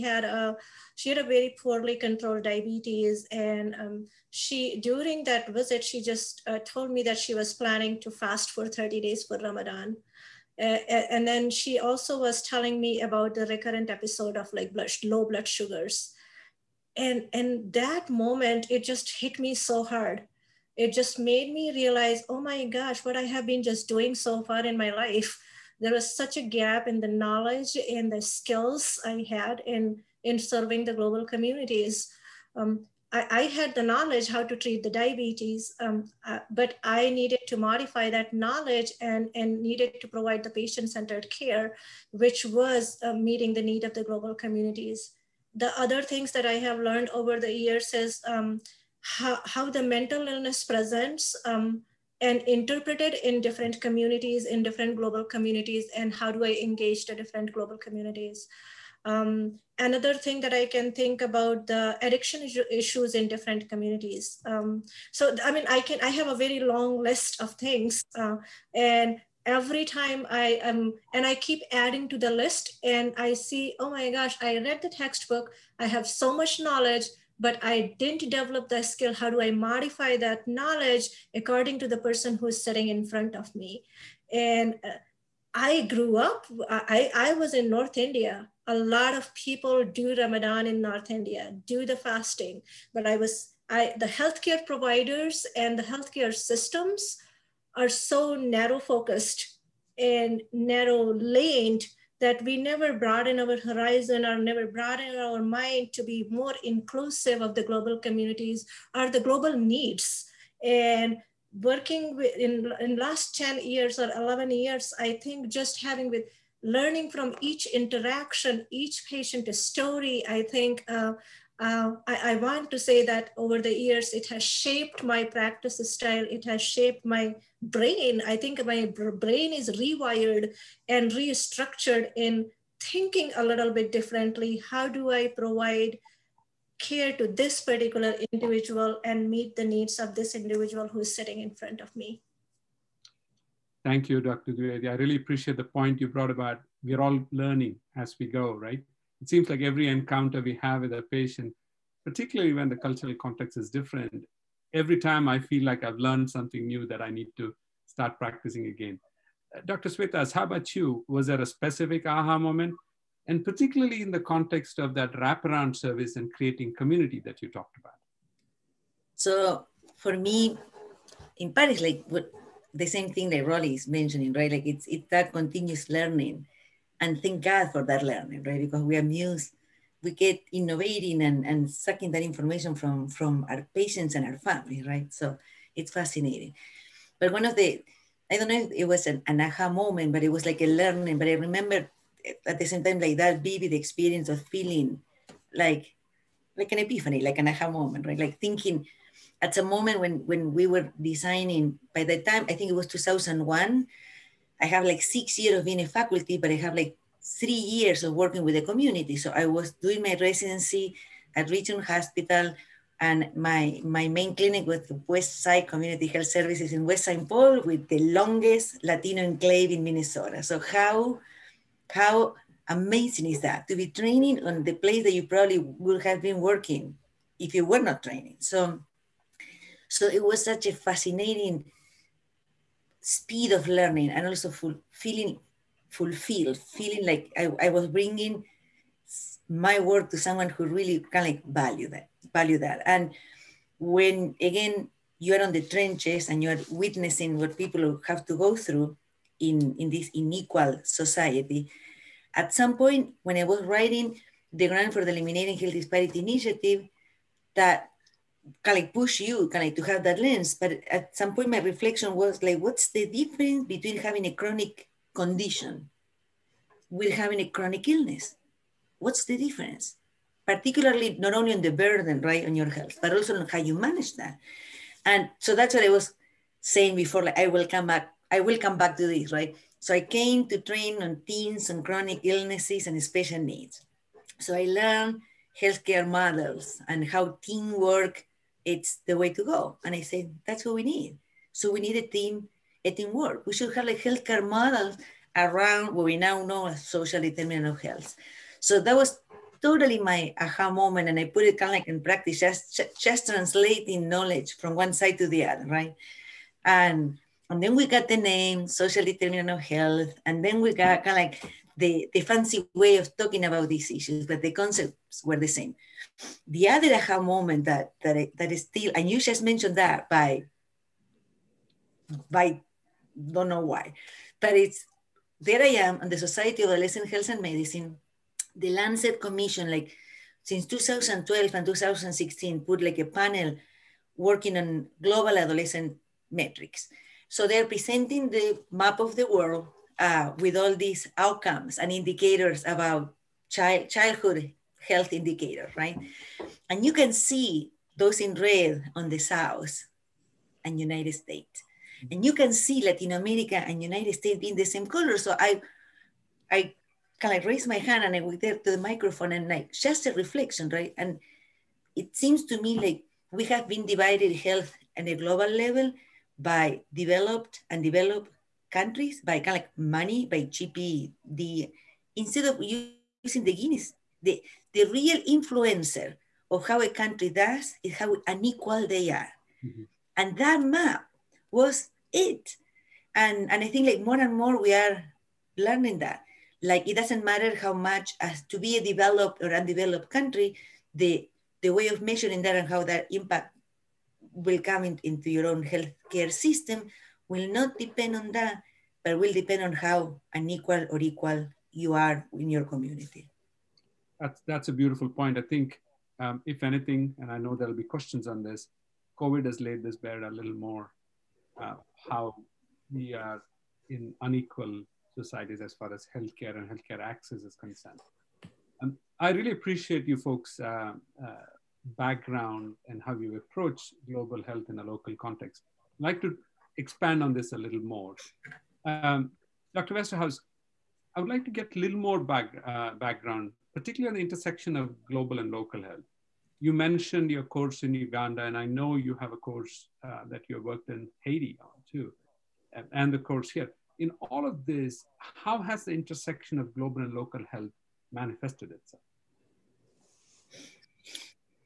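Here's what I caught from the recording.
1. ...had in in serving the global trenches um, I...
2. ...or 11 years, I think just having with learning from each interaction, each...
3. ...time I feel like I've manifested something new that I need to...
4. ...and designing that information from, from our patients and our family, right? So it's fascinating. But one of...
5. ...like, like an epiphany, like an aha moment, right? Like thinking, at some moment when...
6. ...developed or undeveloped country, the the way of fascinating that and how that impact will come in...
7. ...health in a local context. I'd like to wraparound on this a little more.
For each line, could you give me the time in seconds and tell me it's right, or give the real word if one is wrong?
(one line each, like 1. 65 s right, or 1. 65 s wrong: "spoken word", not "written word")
1. 29 s wrong: "communities", not "trenches"
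2. 113 s right
3. 154 s wrong: "learned", not "manifested"
4. 181 s wrong: "sucking", not "designing"
5. 195 s right
6. 388 s wrong: "measuring", not "fascinating"
7. 424 s wrong: "expand", not "wraparound".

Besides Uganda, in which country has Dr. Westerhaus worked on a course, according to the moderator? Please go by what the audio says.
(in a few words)
Haiti.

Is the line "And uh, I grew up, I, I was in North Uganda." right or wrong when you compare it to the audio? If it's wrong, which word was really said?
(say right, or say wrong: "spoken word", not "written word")
wrong: "India", not "Uganda".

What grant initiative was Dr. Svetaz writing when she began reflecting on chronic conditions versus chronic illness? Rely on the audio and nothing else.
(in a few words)
Eliminating Health Disparity Initiative.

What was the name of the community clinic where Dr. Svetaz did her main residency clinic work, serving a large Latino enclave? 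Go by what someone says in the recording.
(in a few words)
West Side Community Health Services.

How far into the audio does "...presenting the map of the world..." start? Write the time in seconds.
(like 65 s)
337 s.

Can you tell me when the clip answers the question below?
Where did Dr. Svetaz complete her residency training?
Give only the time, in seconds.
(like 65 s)
211 s.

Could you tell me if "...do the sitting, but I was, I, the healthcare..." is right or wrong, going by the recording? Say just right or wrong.
wrong.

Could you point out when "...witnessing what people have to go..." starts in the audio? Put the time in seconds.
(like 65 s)
246 s.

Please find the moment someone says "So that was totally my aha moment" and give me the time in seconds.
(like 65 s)
298 s.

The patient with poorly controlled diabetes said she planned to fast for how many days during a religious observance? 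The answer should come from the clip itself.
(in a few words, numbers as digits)
30.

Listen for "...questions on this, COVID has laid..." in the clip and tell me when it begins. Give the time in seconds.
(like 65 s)
407 s.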